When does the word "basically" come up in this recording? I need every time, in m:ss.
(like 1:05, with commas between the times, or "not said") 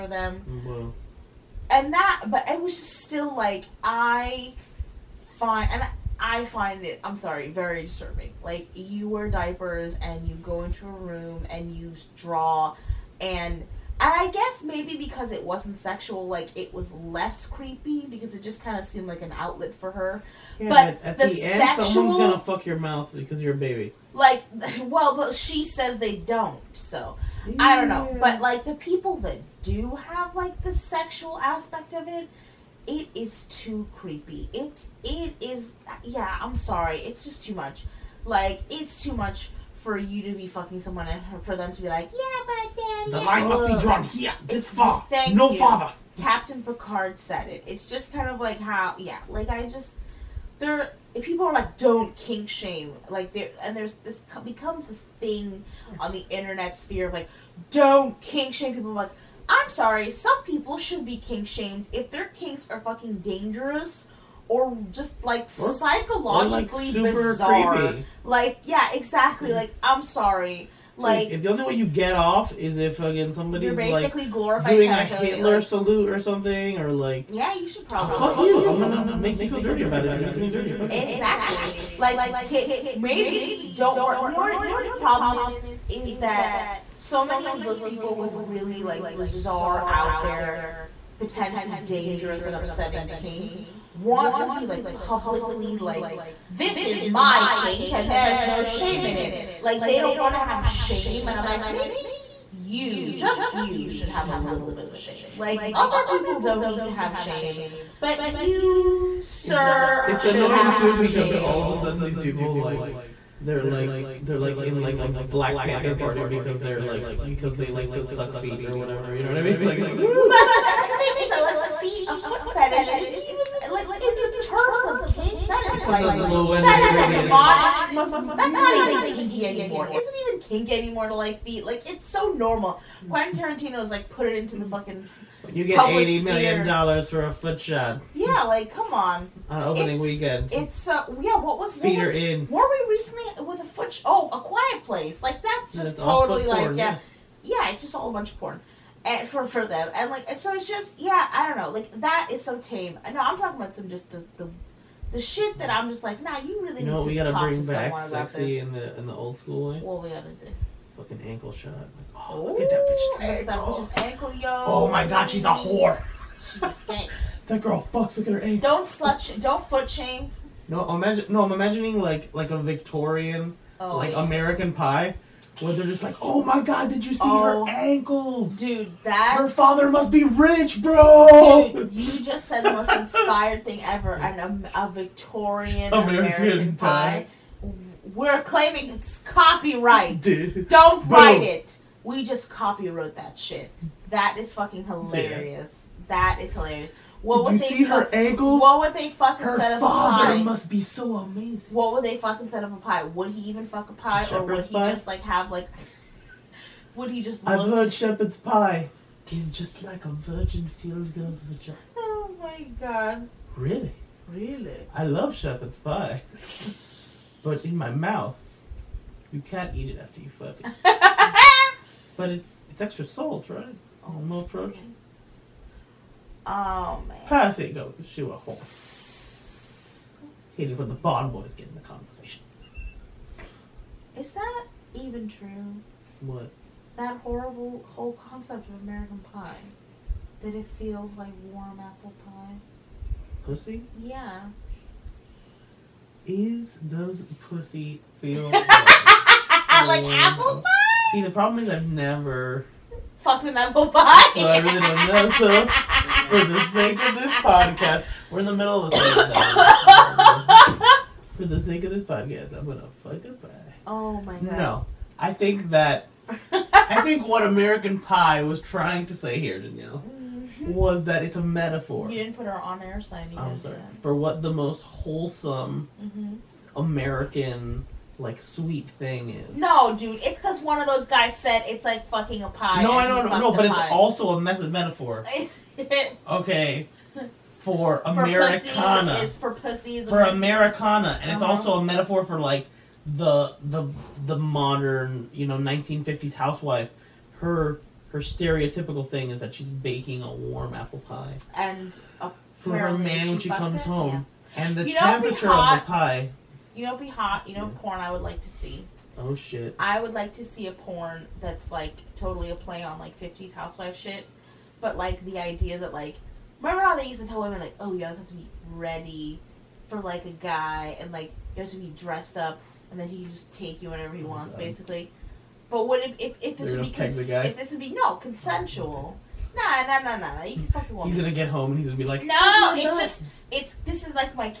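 1:13, 5:24.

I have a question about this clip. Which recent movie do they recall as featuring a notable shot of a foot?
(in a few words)
A Quiet Place.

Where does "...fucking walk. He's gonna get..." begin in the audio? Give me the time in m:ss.
5:30.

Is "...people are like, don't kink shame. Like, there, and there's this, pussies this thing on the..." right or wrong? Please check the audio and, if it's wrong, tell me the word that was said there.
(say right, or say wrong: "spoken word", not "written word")
wrong: "becomes", not "pussies".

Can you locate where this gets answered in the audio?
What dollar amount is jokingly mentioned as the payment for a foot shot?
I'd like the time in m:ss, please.
2:15.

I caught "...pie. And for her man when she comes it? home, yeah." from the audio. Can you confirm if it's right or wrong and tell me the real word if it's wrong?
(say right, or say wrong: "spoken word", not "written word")
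right.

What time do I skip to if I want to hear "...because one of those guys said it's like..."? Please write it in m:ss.
4:40.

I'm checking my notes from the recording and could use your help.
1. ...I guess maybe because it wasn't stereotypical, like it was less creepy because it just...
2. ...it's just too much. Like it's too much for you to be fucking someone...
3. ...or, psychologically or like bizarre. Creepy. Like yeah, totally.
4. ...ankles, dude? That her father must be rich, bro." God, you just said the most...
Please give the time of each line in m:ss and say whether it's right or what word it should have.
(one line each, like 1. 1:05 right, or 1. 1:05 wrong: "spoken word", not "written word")
1. 0:14 wrong: "sexual", not "stereotypical"
2. 0:36 right
3. 1:05 wrong: "exactly", not "totally"
4. 2:57 wrong: "Dude", not "God".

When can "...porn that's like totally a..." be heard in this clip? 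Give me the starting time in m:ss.
5:10.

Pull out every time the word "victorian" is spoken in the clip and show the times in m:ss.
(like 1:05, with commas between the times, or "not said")
2:52, 3:04.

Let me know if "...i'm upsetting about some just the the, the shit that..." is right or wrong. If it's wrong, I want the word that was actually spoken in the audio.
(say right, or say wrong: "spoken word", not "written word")
wrong: "talking", not "upsetting".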